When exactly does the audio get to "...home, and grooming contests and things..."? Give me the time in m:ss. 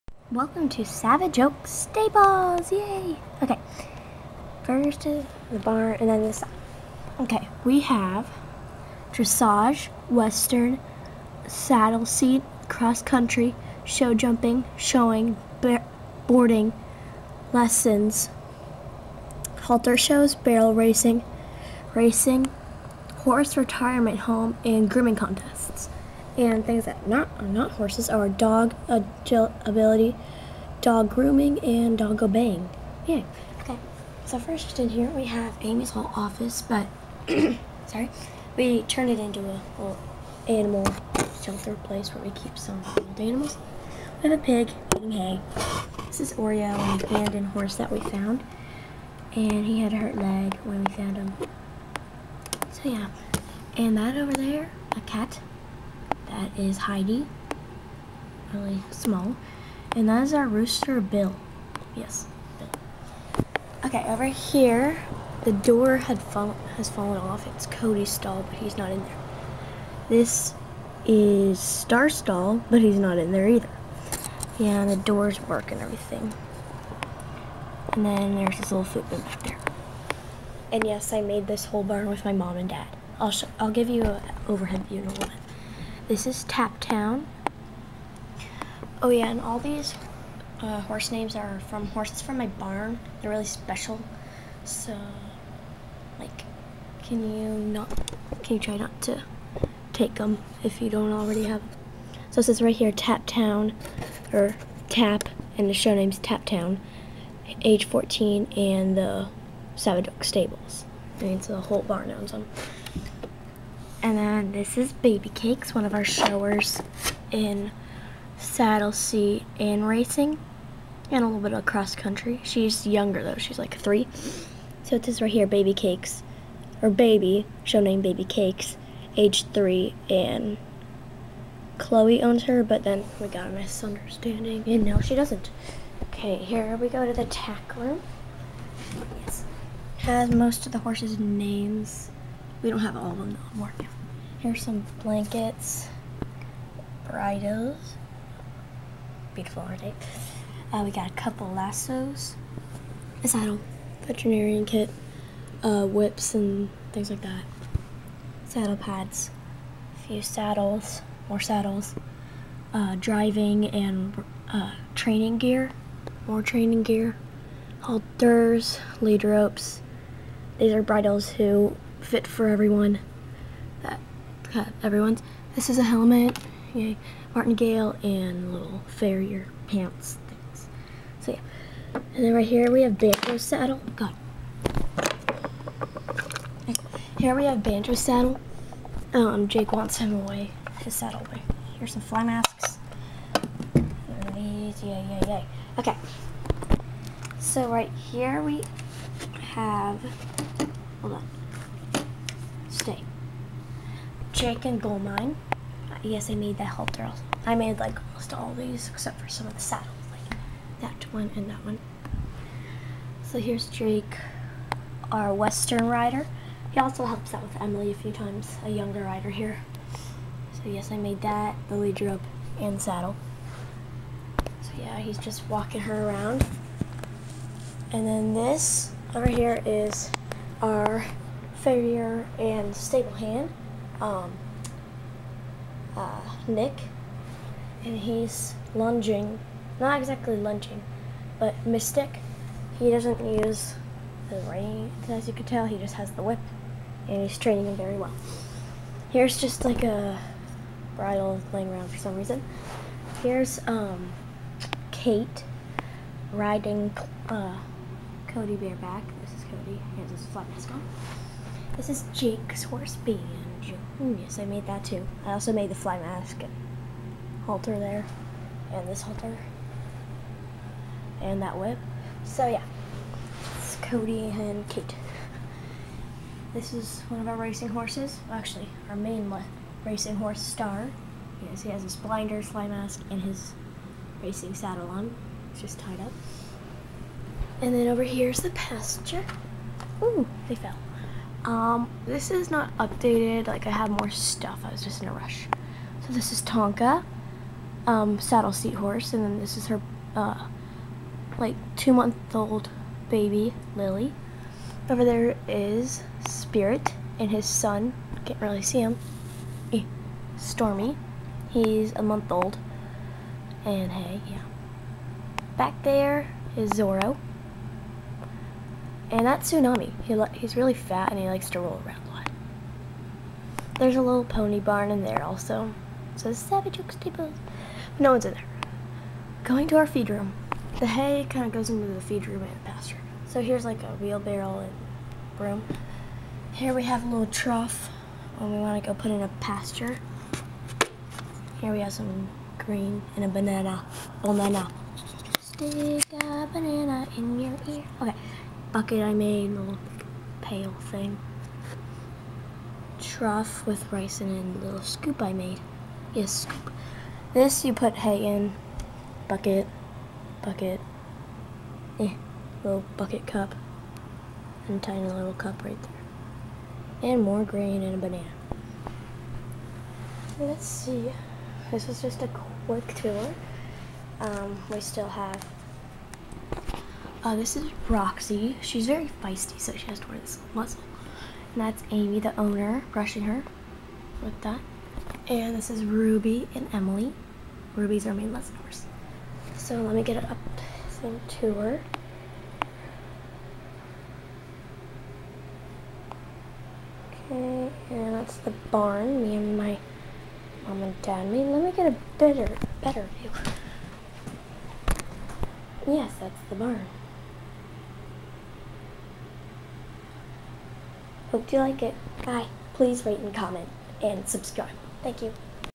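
0:24.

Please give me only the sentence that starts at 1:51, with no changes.
I mean, it's a whole barn owns them.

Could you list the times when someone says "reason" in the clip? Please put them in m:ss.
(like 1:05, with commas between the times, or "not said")
4:12.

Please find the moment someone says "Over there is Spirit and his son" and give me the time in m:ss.
5:04.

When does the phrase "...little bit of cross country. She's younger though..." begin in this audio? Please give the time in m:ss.
2:01.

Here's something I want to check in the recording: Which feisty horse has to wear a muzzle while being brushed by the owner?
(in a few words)
Roxy.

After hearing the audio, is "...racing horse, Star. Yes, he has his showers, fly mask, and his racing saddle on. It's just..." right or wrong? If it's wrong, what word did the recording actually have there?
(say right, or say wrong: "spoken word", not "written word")
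wrong: "blinders", not "showers".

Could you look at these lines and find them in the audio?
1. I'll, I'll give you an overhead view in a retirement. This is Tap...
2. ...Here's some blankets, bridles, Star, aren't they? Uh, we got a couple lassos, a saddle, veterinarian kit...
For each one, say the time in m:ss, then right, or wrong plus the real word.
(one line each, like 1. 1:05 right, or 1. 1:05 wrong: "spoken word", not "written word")
1. 1:23 wrong: "moment", not "retirement"
2. 2:24 wrong: "Beautiful", not "Star".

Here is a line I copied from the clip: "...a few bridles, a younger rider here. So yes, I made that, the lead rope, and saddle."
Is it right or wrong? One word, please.
wrong.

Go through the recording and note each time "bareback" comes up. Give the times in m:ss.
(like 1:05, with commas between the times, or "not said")
4:18.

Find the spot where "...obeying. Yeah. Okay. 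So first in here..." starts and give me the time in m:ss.
0:32.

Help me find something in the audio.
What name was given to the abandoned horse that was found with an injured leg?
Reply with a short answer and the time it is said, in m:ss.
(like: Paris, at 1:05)
Oreo, at 0:46.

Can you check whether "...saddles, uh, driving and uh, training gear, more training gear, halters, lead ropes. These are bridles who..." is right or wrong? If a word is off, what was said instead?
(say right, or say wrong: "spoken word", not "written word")
right.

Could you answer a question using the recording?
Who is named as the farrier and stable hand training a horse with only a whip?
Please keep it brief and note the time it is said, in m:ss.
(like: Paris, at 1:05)
Nick, at 3:56.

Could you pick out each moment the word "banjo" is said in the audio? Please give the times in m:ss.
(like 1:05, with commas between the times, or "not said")
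3:02, 3:07.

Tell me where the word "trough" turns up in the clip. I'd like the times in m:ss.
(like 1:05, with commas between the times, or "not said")
5:37, 5:53.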